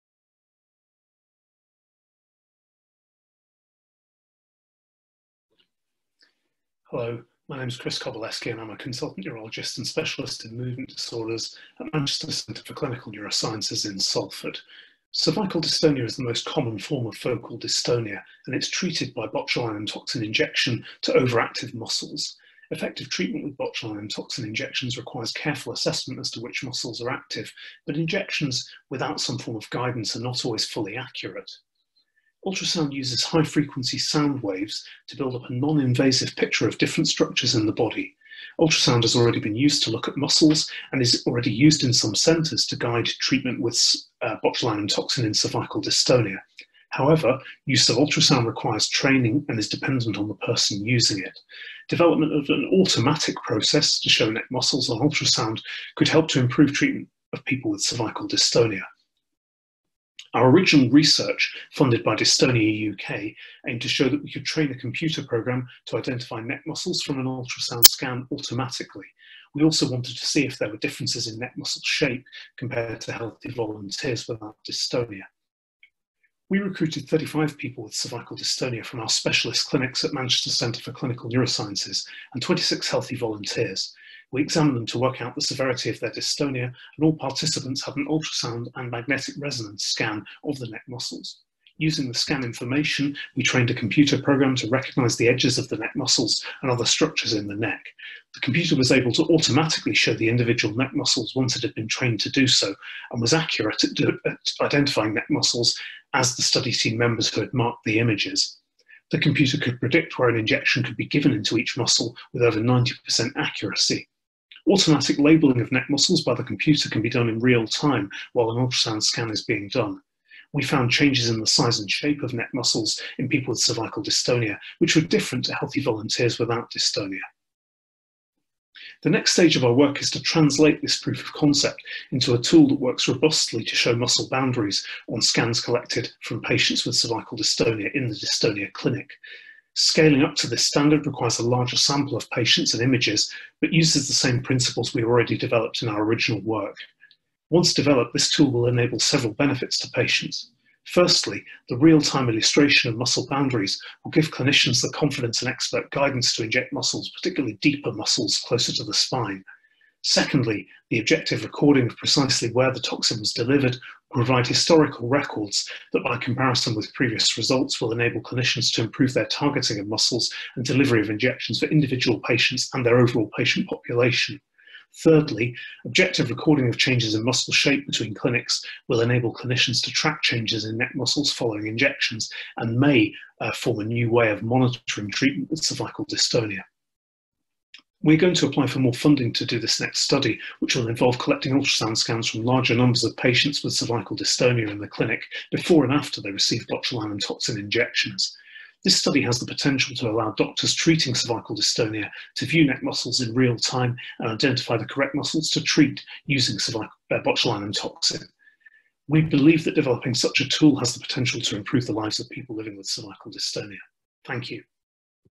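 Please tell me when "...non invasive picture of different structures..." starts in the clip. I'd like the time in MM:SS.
00:35.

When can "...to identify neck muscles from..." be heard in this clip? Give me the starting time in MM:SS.
01:05.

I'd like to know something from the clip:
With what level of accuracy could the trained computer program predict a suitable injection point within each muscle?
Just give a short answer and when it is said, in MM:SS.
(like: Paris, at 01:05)
over 90%, at 01:52.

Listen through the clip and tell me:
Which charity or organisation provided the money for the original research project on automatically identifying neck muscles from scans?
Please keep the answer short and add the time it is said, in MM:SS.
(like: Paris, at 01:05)
Dystonia UK, at 01:02.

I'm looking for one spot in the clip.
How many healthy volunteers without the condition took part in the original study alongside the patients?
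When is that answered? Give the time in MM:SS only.
01:22.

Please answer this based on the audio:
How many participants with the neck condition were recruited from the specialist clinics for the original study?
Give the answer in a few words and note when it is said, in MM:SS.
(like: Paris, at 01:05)
35, at 01:17.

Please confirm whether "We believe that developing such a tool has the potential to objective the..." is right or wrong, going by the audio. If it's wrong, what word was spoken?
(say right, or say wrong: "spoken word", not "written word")
wrong: "improve", not "objective".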